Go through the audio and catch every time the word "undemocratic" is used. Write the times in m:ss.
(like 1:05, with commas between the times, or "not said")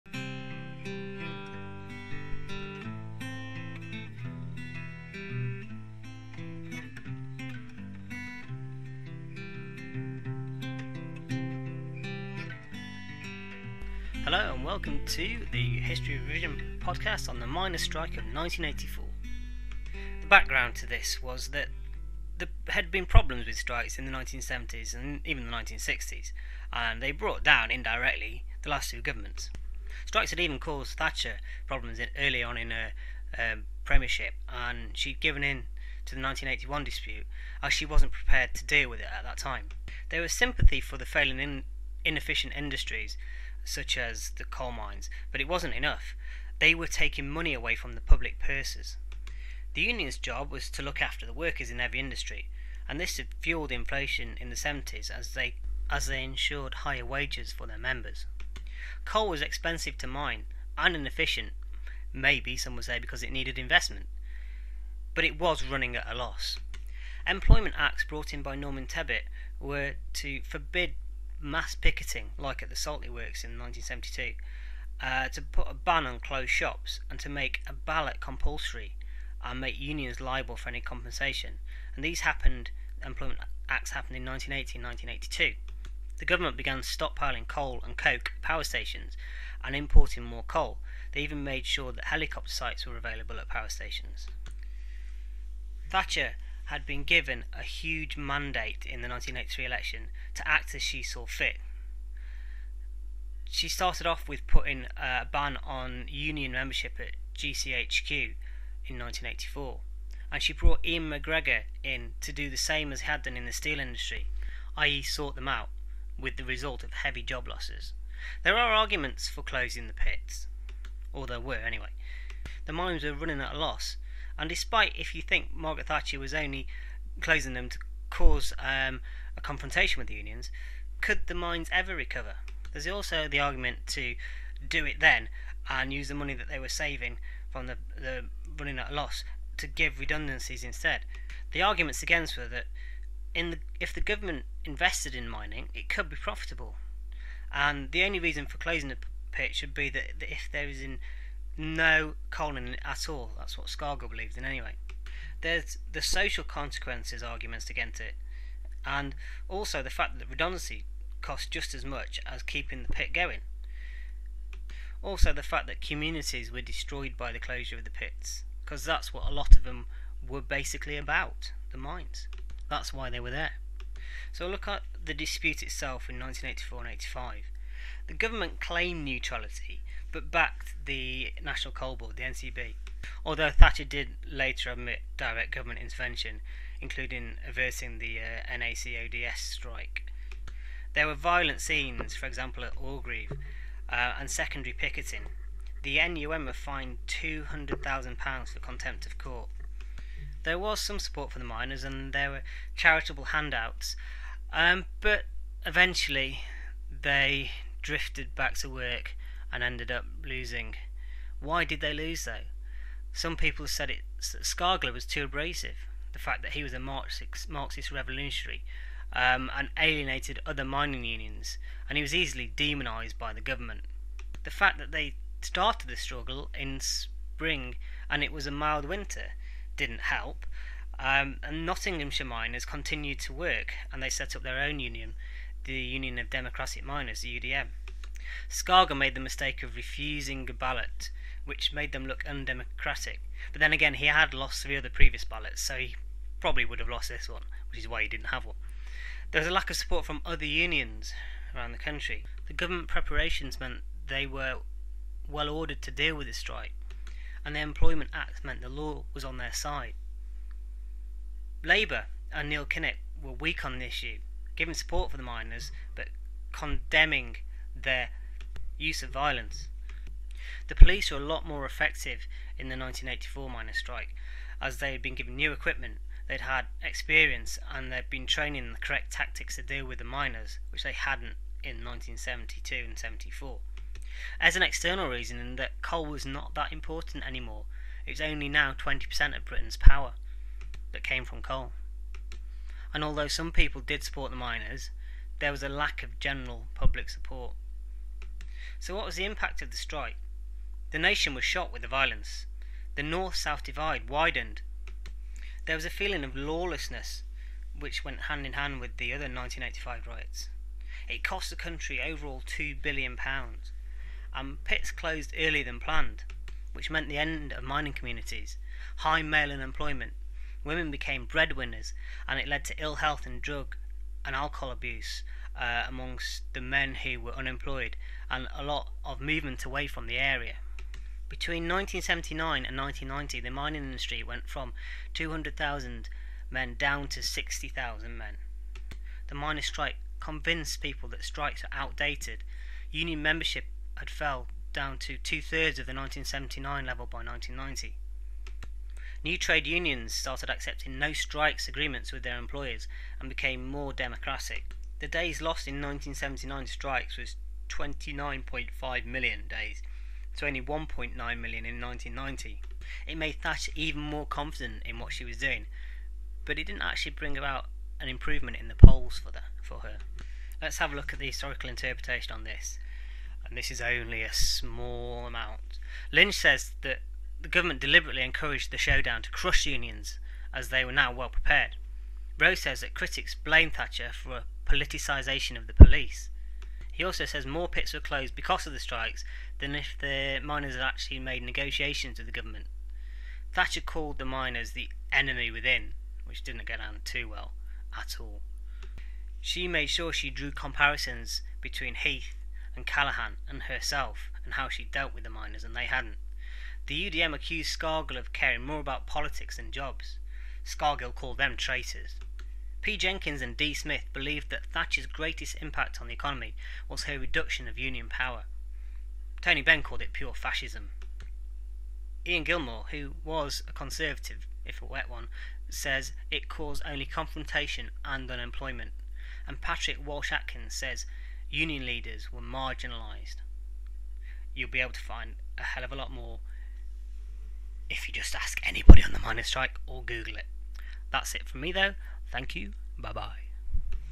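4:02.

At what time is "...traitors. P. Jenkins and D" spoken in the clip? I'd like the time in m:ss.
6:51.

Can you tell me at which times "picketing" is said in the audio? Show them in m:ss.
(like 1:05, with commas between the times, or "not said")
1:11, 3:14.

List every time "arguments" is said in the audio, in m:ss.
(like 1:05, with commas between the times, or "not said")
1:58, 2:13, 2:21, 2:37.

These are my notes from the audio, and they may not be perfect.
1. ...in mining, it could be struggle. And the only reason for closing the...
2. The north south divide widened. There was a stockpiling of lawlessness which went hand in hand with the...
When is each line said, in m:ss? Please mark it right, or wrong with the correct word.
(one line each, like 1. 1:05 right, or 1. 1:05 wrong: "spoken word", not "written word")
1. 2:25 wrong: "profitable", not "struggle"
2. 5:02 wrong: "feeling", not "stockpiling".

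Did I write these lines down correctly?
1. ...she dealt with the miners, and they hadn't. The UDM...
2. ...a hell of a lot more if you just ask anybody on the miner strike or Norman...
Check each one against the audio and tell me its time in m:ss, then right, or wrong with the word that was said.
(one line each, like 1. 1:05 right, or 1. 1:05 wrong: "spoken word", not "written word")
1. 6:44 right
2. 7:15 wrong: "Google", not "Norman".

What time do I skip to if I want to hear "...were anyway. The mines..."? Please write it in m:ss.
2:01.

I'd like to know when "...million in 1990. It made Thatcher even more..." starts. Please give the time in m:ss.
6:01.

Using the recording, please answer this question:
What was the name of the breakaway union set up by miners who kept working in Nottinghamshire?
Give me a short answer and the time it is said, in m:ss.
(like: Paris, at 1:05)
Union of Democratic Miners, at 3:55.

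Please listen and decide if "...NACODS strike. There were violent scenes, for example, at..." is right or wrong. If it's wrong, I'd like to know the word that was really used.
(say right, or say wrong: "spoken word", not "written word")
right.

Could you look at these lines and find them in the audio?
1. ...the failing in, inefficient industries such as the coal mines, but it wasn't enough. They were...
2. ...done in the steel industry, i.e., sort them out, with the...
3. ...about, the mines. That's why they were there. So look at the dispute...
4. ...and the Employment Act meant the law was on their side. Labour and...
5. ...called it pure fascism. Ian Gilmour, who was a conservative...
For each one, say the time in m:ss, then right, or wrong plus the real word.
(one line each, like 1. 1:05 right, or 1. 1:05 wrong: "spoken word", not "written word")
1. 0:40 right
2. 1:53 right
3. 2:50 right
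4. 4:17 right
5. 6:59 right.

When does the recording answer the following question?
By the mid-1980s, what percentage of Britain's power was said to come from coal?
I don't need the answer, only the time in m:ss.
4:48.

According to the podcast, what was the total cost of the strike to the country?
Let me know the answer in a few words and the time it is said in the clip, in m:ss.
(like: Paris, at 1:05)
£2 billion, at 5:12.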